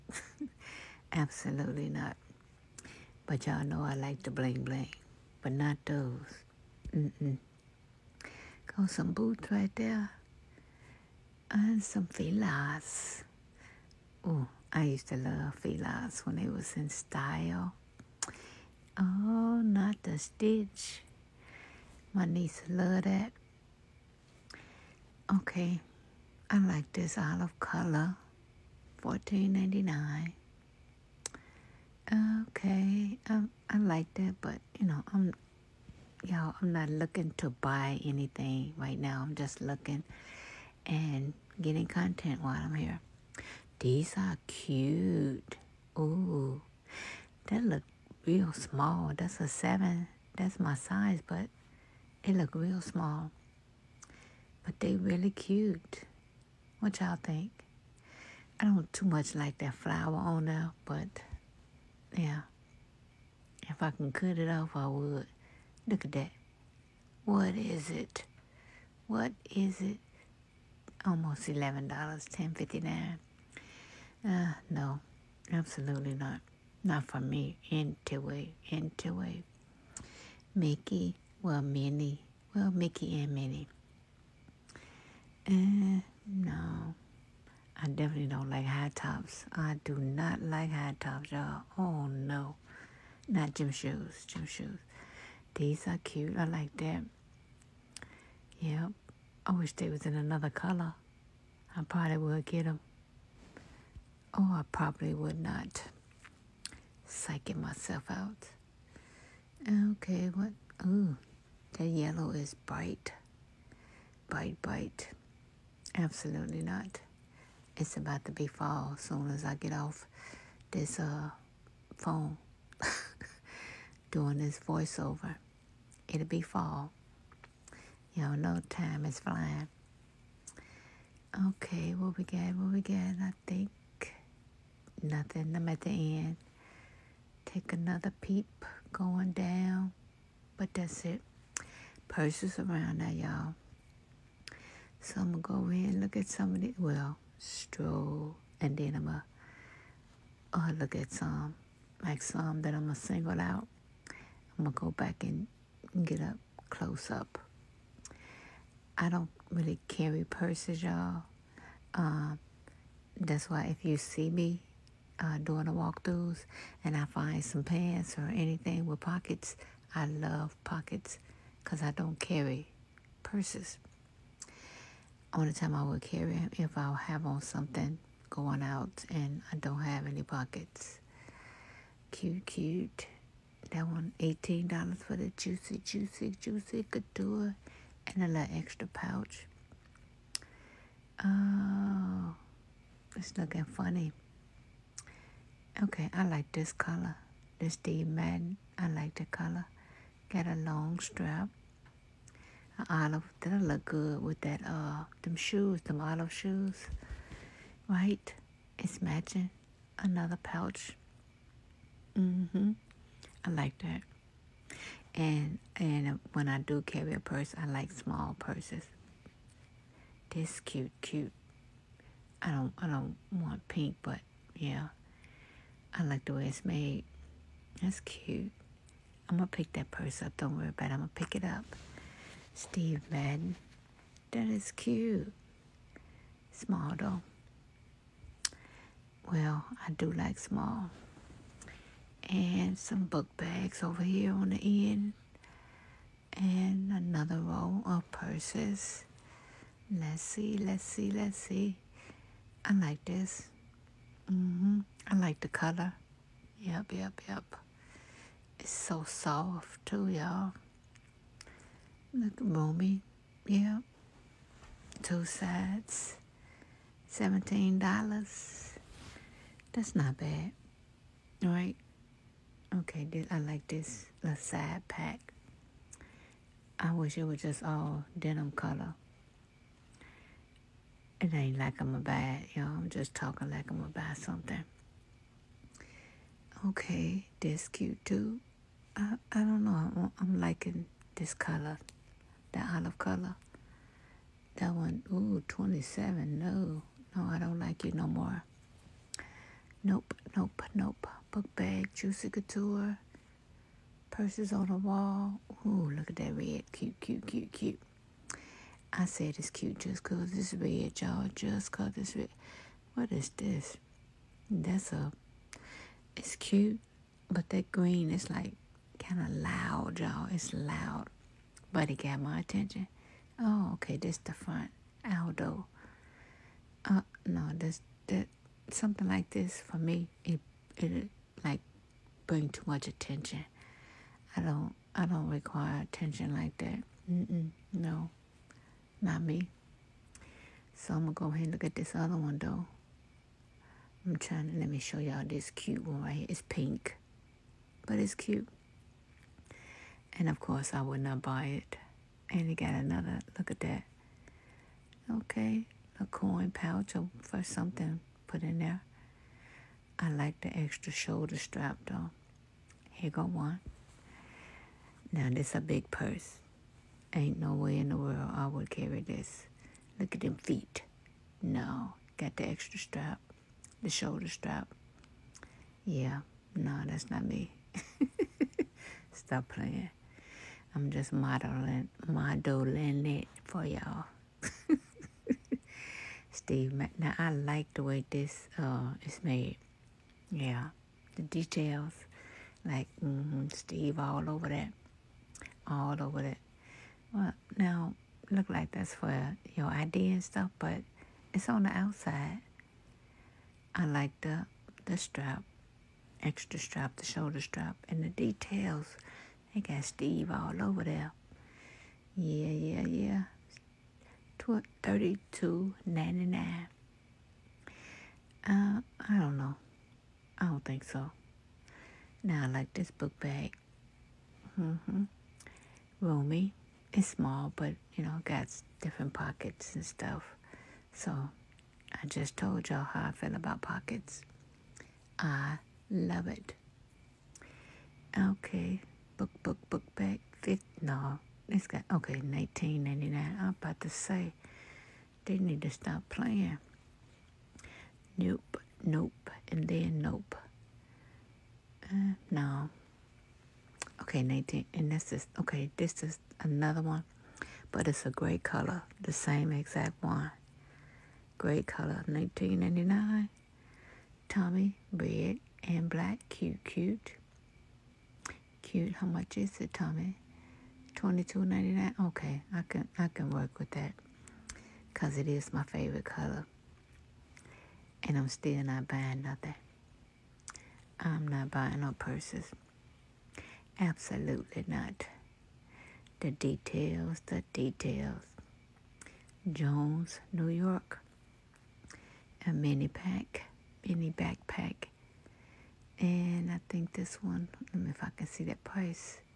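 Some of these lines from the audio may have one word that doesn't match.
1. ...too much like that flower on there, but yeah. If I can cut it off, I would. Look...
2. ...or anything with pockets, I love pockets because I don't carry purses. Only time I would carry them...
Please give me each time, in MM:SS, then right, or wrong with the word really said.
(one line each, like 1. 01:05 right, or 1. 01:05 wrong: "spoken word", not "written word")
1. 00:58 right
2. 02:48 right.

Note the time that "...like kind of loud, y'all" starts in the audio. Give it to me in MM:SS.
05:18.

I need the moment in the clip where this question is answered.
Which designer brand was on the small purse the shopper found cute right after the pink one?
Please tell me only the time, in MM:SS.
03:52.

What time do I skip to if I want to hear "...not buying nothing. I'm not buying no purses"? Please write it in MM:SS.
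07:58.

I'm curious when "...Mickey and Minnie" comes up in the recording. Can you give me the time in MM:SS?
01:22.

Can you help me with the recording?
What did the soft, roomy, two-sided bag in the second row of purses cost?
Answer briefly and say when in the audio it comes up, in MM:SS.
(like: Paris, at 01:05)
$17, at 04:27.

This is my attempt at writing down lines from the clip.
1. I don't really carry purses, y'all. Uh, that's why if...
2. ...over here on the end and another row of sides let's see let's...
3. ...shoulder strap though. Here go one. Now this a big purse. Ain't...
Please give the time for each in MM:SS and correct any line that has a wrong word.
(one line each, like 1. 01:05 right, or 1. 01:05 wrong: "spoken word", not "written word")
1. 02:39 right
2. 04:03 wrong: "purses", not "sides"
3. 06:00 right.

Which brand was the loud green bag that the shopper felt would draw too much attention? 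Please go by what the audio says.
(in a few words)
Aldo.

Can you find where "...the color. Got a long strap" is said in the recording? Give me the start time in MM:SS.
03:19.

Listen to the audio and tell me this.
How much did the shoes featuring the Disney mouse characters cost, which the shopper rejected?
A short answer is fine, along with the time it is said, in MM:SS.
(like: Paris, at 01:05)
$10.59, at 01:12.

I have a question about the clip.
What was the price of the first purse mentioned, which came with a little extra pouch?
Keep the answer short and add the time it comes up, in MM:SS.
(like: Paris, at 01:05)
$18, at 03:04.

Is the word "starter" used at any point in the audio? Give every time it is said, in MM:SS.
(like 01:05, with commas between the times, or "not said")
not said.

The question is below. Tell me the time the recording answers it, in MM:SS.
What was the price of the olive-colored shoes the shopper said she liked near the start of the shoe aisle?
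00:28.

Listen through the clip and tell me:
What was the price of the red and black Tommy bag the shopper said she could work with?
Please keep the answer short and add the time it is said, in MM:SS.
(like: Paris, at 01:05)
$22.99, at 07:50.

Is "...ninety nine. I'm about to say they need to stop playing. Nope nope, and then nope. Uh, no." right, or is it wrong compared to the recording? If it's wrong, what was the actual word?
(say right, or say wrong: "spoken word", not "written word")
right.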